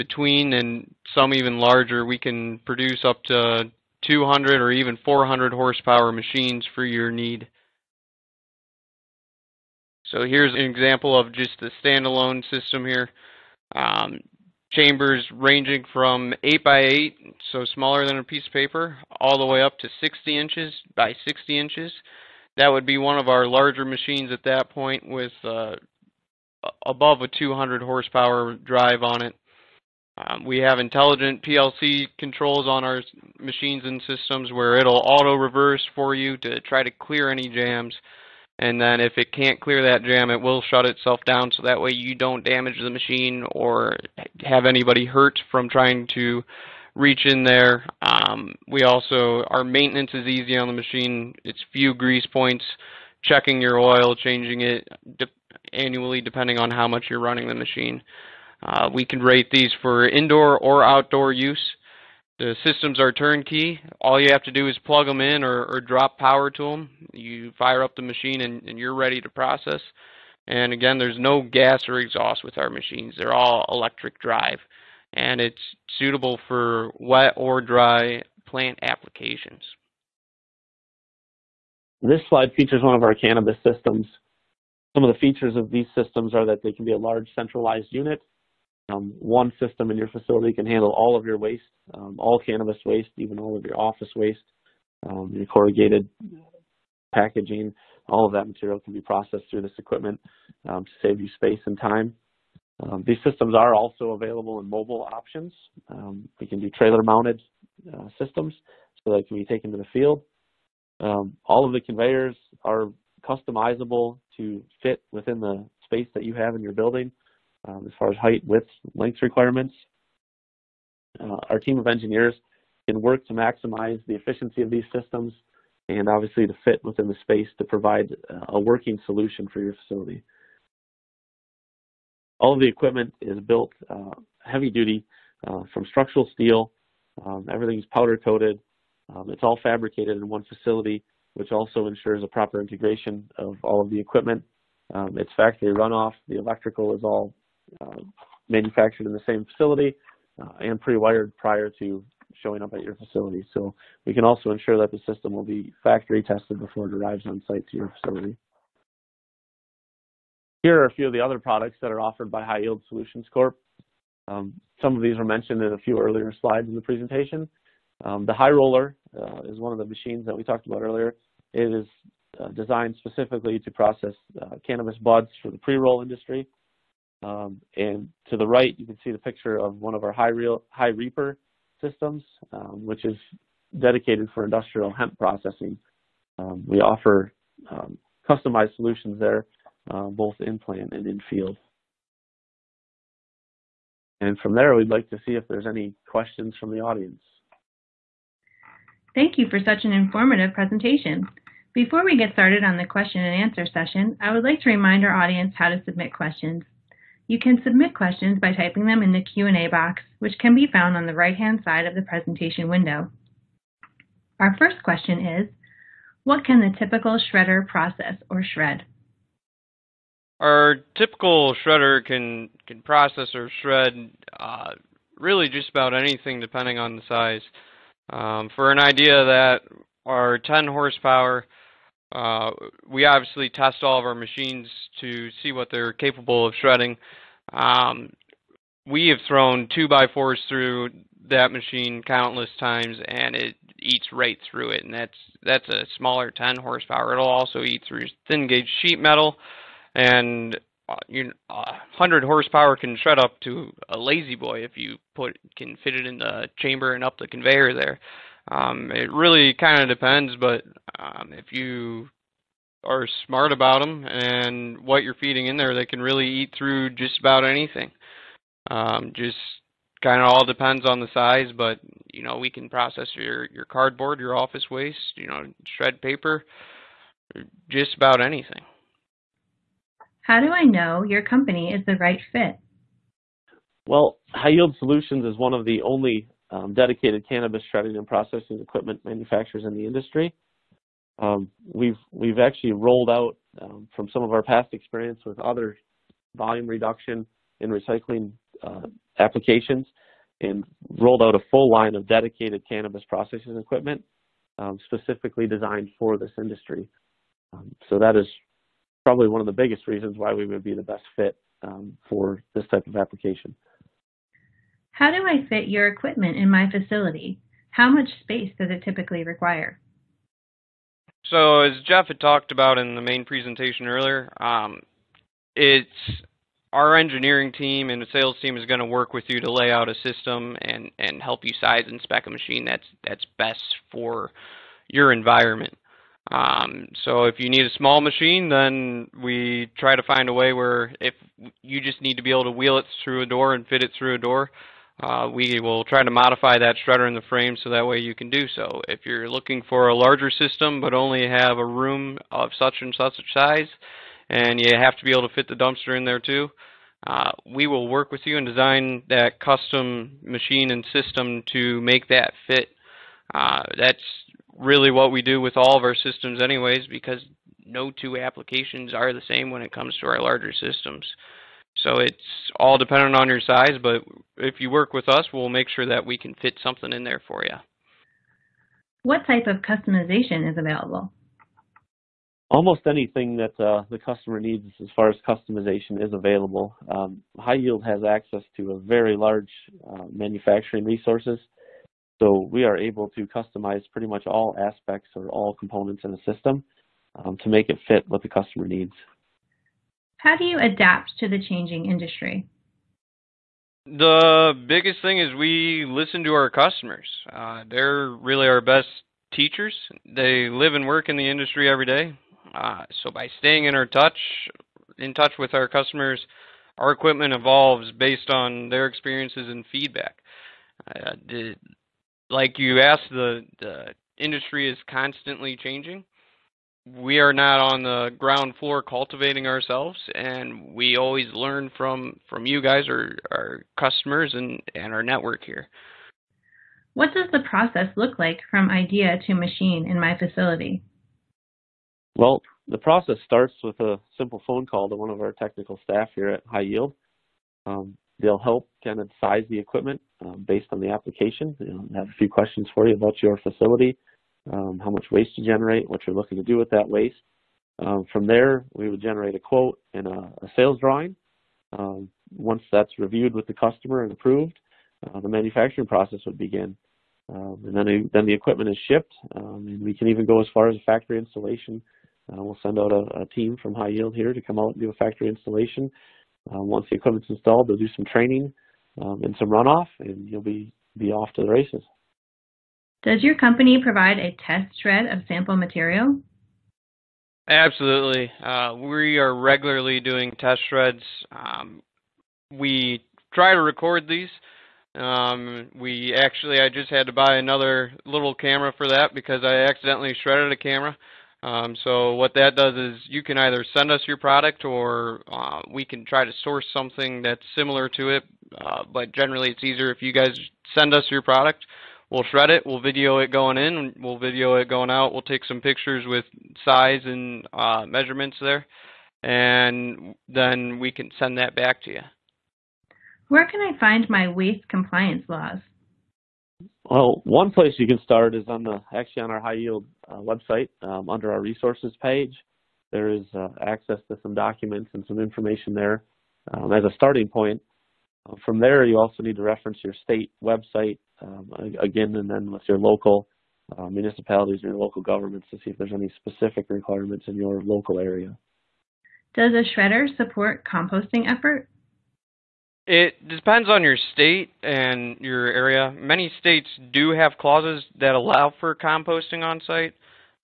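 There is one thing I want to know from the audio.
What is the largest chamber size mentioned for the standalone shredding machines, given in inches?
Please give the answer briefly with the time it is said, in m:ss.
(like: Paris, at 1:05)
60 inches by 60 inches, at 0:20.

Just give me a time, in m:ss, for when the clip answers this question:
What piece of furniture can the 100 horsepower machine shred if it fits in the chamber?
4:13.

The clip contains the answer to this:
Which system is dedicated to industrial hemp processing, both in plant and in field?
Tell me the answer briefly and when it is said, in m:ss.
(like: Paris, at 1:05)
high reaper, at 3:00.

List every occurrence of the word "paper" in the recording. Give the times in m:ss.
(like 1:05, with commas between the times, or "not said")
0:18, 4:36.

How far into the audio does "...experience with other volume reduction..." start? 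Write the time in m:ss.
4:54.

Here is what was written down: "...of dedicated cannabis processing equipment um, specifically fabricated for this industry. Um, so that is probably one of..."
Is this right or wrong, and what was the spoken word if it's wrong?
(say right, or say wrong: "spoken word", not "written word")
wrong: "designed", not "fabricated".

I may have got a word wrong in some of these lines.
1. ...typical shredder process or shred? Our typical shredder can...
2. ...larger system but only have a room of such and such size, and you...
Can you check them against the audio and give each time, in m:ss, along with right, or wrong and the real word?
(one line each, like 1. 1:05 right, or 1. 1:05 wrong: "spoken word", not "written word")
1. 3:36 right
2. 5:49 right.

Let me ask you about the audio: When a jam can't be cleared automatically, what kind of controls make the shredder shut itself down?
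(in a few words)
intelligent PLC controls.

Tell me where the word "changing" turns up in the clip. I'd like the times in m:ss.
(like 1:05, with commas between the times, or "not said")
0:54, 6:41, 7:05.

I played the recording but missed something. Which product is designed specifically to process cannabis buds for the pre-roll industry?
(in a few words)
high roller.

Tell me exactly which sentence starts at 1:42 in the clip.
Um, these systems are also available in mobile options.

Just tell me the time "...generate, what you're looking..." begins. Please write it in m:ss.
7:35.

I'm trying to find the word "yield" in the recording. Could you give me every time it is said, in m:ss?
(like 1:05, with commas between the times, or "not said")
2:42, 4:44, 6:27, 7:26, 7:53, 8:49.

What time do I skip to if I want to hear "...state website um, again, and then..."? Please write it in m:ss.
9:00.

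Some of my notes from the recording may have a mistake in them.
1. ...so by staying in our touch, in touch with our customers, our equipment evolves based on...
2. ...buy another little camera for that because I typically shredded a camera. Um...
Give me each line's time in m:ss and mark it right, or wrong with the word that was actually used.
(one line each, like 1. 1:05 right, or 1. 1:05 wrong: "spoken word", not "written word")
1. 6:53 right
2. 8:17 wrong: "accidentally", not "typically".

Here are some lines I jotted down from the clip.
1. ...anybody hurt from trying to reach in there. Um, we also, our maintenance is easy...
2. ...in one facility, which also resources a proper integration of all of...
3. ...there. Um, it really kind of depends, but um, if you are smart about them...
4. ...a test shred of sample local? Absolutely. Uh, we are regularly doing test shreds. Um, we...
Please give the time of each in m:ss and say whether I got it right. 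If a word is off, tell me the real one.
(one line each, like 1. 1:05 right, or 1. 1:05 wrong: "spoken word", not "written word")
1. 0:44 right
2. 2:20 wrong: "ensures", not "resources"
3. 4:17 right
4. 8:04 wrong: "material", not "local".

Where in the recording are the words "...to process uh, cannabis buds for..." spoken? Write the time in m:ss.
2:53.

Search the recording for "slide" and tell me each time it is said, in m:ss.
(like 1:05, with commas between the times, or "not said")
1:22, 2:46.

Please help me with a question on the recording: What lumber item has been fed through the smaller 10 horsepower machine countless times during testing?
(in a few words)
two by fours.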